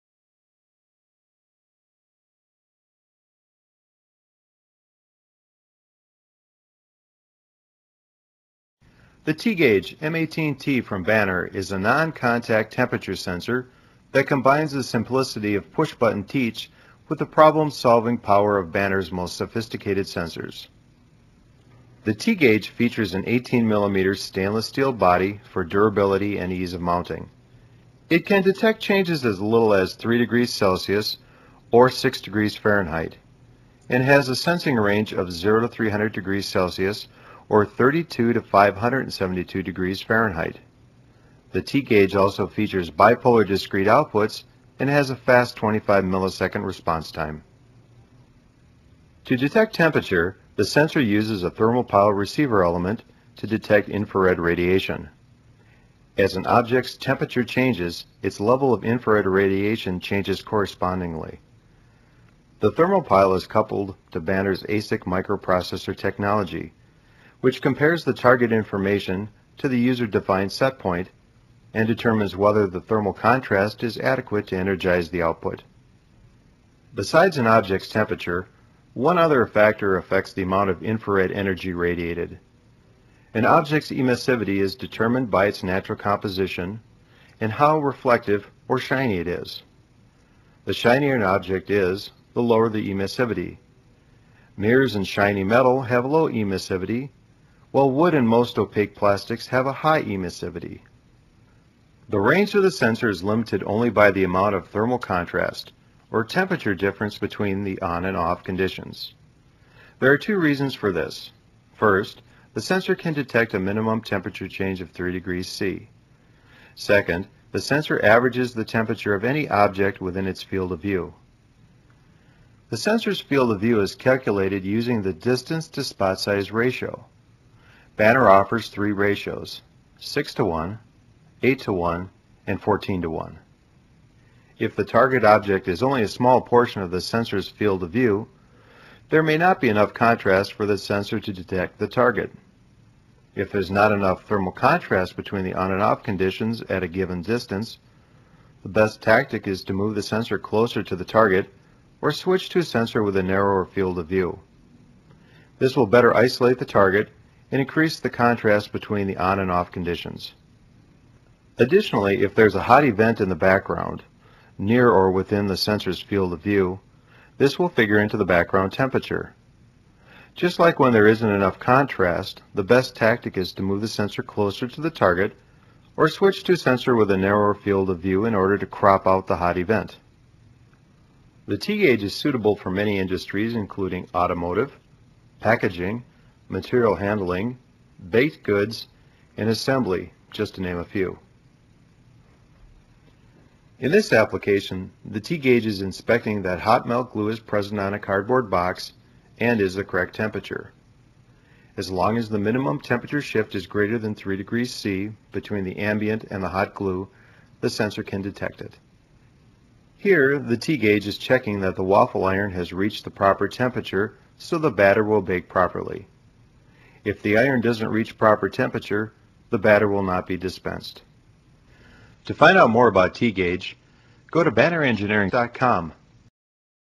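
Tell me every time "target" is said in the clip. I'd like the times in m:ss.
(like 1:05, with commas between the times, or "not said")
1:08, 2:14, 2:21, 2:31, 2:36, 2:54.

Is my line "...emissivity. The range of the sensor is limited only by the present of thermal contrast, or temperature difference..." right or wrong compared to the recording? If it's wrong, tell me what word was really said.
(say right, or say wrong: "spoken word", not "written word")
wrong: "amount", not "present".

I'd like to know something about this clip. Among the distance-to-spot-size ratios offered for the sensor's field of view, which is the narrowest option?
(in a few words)
14 to 1.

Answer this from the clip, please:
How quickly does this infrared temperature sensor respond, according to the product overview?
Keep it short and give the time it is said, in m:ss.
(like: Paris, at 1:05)
25 milliseconds, at 0:45.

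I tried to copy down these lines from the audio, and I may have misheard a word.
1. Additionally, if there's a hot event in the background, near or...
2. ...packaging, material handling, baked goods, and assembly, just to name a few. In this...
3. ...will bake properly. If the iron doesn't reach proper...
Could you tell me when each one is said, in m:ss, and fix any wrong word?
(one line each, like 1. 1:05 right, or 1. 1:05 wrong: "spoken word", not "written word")
1. 2:41 right
2. 3:05 right
3. 3:35 right.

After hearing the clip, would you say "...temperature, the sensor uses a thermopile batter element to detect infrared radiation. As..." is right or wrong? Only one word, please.
wrong.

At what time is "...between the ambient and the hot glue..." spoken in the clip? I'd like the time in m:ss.
3:25.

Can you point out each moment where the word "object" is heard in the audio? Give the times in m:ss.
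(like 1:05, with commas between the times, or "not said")
0:56, 1:17, 1:23, 1:31, 1:59, 2:15.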